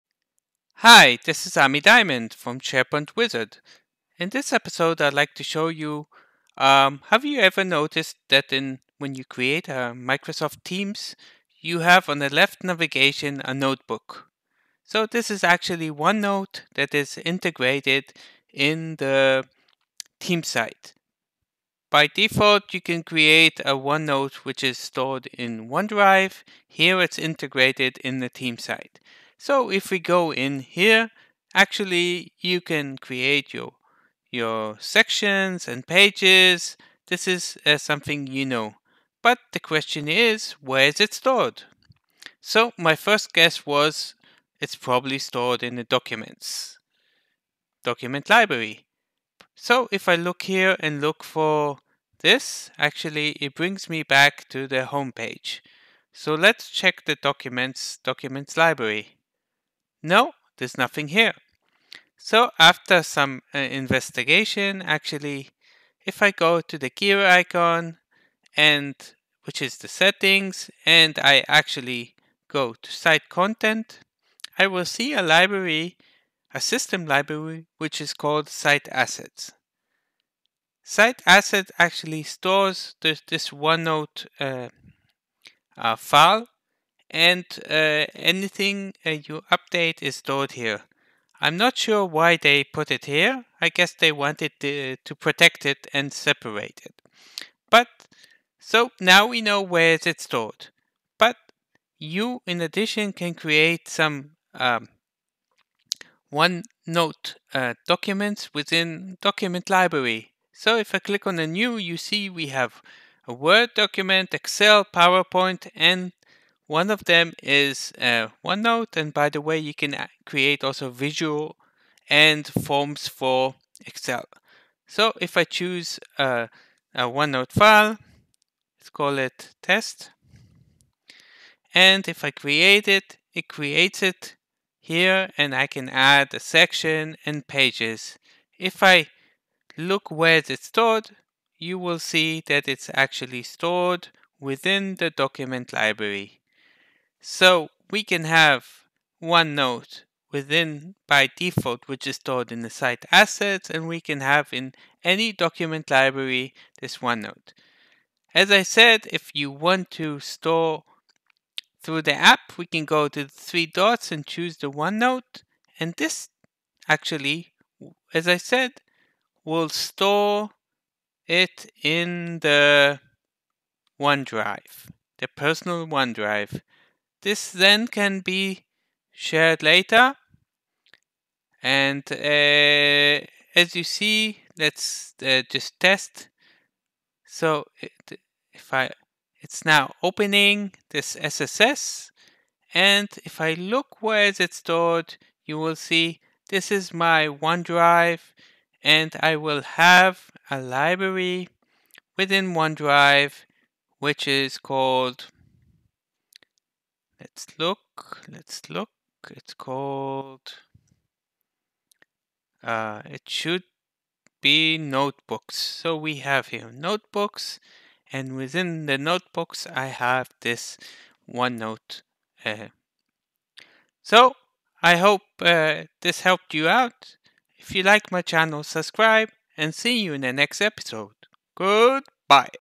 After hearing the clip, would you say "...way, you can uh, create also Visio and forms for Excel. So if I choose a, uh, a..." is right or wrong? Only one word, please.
right.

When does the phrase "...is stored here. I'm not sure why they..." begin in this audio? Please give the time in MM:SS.
01:30.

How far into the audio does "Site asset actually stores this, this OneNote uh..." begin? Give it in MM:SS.
01:20.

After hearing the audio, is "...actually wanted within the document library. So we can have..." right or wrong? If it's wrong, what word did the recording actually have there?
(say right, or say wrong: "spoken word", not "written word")
wrong: "stored", not "wanted".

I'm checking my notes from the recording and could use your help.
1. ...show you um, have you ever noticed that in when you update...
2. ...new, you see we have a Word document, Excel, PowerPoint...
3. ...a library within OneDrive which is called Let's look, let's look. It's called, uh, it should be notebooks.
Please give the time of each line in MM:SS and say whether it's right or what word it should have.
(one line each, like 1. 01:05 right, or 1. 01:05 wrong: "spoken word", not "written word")
1. 00:05 wrong: "create", not "update"
2. 01:51 right
3. 03:20 right.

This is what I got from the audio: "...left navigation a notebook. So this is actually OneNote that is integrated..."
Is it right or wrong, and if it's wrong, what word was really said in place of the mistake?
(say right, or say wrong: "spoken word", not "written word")
right.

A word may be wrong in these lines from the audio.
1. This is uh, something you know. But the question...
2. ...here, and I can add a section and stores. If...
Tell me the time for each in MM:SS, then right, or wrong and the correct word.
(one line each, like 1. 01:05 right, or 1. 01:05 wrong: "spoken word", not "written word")
1. 00:37 right
2. 02:14 wrong: "pages", not "stores".